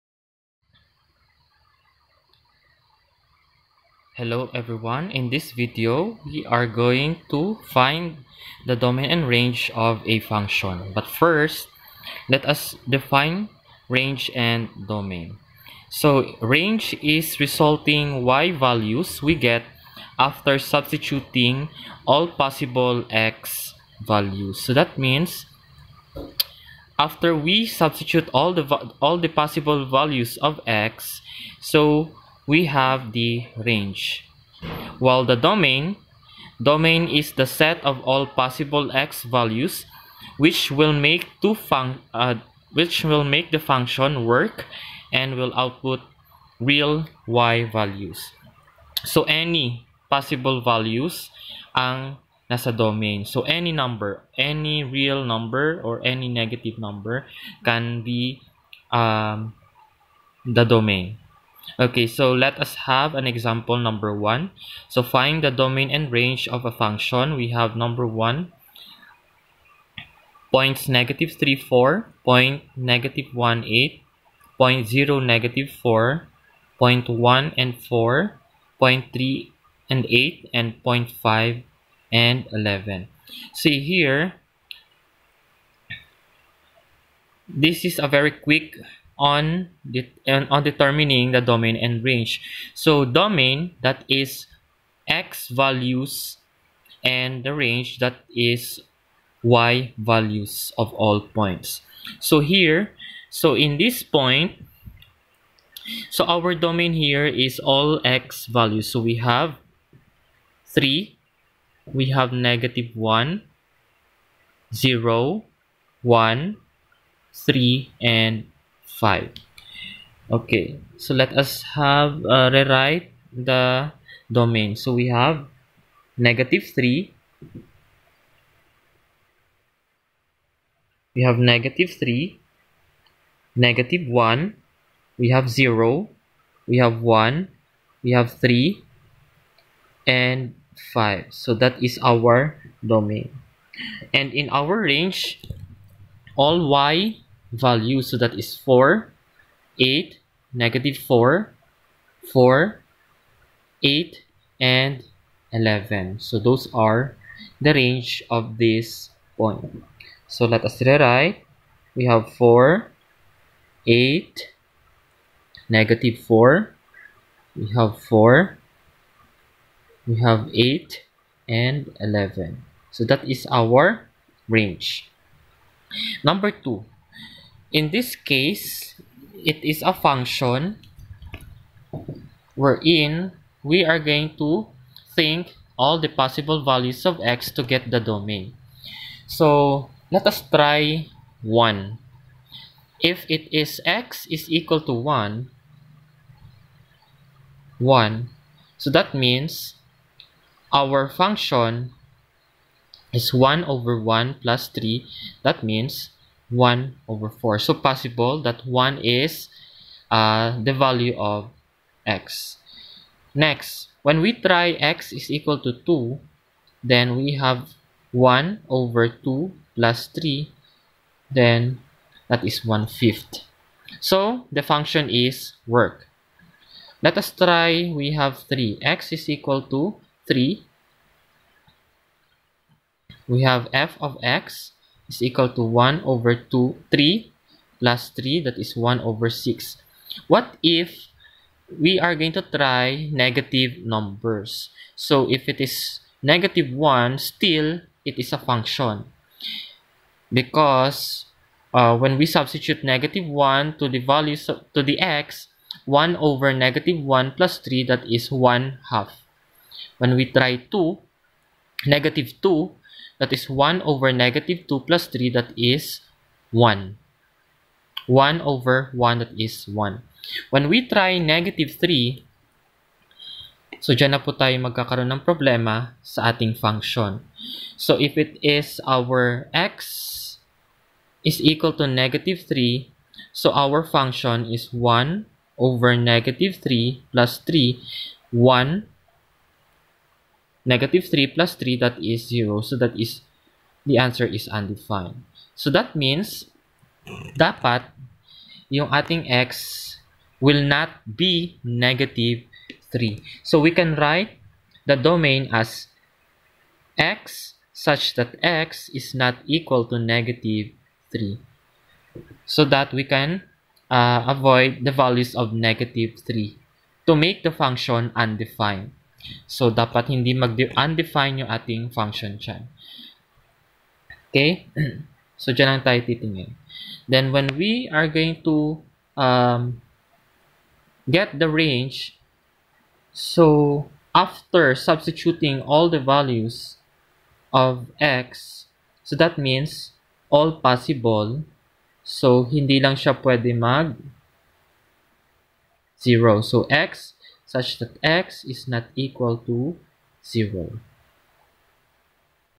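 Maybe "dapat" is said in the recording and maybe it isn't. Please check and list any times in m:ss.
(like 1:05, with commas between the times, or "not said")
4:57, 5:19.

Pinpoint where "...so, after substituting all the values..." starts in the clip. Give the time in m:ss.
5:33.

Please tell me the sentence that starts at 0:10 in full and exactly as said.
But first, let us define range and domain.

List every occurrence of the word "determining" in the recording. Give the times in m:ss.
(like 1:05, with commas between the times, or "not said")
1:30.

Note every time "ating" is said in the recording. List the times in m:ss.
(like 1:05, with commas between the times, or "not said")
4:36, 4:58, 5:21.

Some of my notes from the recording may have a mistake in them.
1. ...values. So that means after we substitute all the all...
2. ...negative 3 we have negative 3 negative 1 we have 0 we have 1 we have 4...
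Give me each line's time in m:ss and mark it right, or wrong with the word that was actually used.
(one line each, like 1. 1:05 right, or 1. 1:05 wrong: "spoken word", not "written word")
1. 0:24 right
2. 2:06 wrong: "3", not "4".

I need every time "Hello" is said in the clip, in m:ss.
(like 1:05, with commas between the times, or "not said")
0:04.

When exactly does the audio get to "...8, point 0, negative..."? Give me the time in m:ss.
1:13.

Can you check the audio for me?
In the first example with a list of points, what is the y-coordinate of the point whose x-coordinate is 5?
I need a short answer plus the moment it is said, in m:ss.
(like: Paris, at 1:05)
11, at 1:20.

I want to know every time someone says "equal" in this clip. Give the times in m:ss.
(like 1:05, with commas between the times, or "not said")
3:14, 3:35, 3:49, 3:55, 4:41, 5:09, 5:48.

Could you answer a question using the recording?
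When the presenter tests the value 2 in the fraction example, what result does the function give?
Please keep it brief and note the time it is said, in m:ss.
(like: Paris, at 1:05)
1/5, at 3:42.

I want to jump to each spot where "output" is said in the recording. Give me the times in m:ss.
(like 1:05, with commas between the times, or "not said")
0:45.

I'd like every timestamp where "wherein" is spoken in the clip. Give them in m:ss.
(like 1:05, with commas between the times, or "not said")
3:02.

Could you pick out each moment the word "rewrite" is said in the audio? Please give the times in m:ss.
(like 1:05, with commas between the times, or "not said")
2:02, 2:40.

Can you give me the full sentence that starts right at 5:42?
So, hindi lang siya pwede mag 0.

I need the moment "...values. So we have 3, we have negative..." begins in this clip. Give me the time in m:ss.
1:48.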